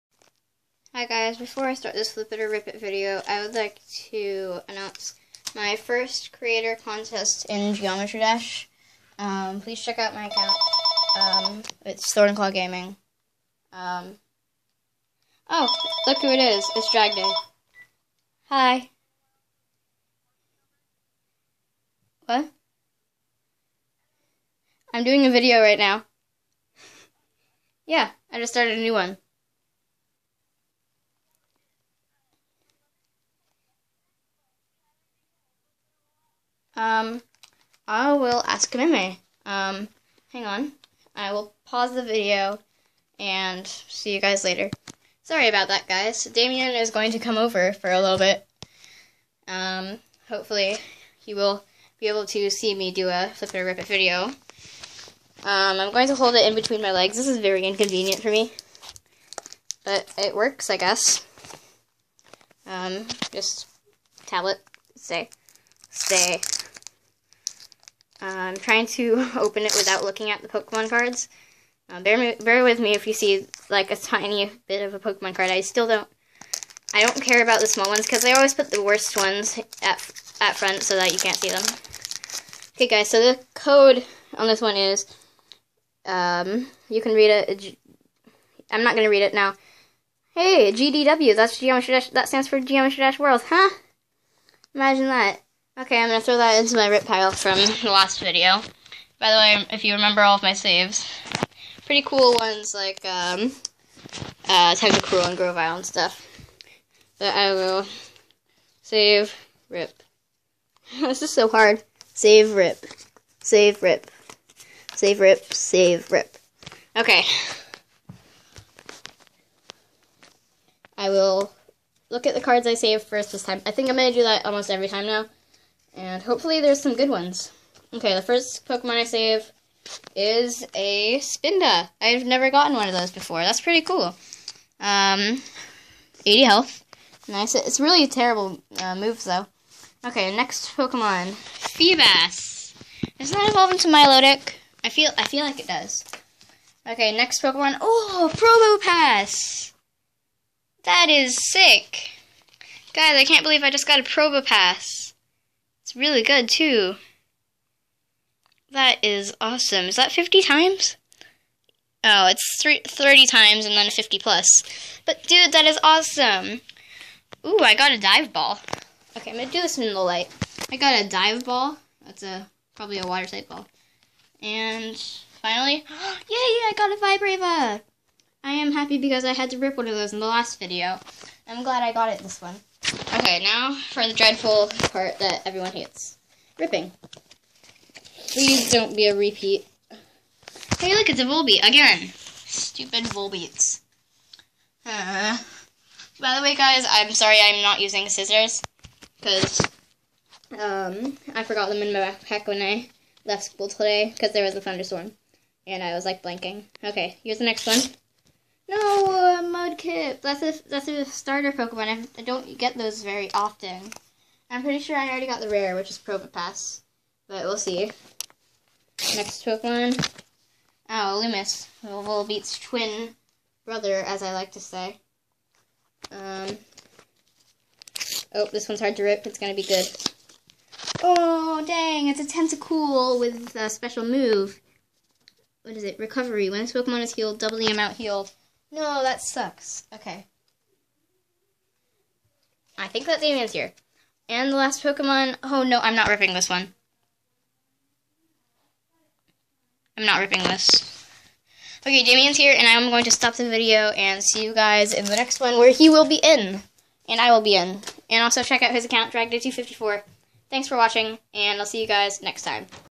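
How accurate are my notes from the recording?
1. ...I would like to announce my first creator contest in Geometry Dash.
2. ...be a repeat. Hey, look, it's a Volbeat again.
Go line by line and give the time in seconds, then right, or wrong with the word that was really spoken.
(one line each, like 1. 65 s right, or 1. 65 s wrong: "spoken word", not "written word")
1. 3 s right
2. 188 s right.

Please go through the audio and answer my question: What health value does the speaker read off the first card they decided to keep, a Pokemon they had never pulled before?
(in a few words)
80.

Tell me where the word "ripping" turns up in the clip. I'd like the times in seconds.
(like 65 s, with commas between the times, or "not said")
186 s, 246 s, 250 s.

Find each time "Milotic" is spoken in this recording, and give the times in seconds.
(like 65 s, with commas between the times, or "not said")
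143 s.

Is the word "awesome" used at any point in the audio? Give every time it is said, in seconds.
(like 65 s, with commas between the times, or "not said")
159 s, 165 s.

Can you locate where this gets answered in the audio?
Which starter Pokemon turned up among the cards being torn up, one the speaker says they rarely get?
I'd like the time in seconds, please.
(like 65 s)
209 s.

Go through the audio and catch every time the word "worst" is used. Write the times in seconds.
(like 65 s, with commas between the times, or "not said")
78 s.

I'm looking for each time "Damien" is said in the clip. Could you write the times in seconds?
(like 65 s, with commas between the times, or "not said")
46 s, 252 s.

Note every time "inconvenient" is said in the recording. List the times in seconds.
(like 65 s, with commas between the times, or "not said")
57 s.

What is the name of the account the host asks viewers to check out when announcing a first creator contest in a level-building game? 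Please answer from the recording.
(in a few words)
Thorn Claw Gaming.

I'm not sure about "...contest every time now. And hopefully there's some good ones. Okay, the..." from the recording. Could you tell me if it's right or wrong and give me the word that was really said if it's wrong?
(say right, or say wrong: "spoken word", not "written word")
wrong: "almost", not "contest".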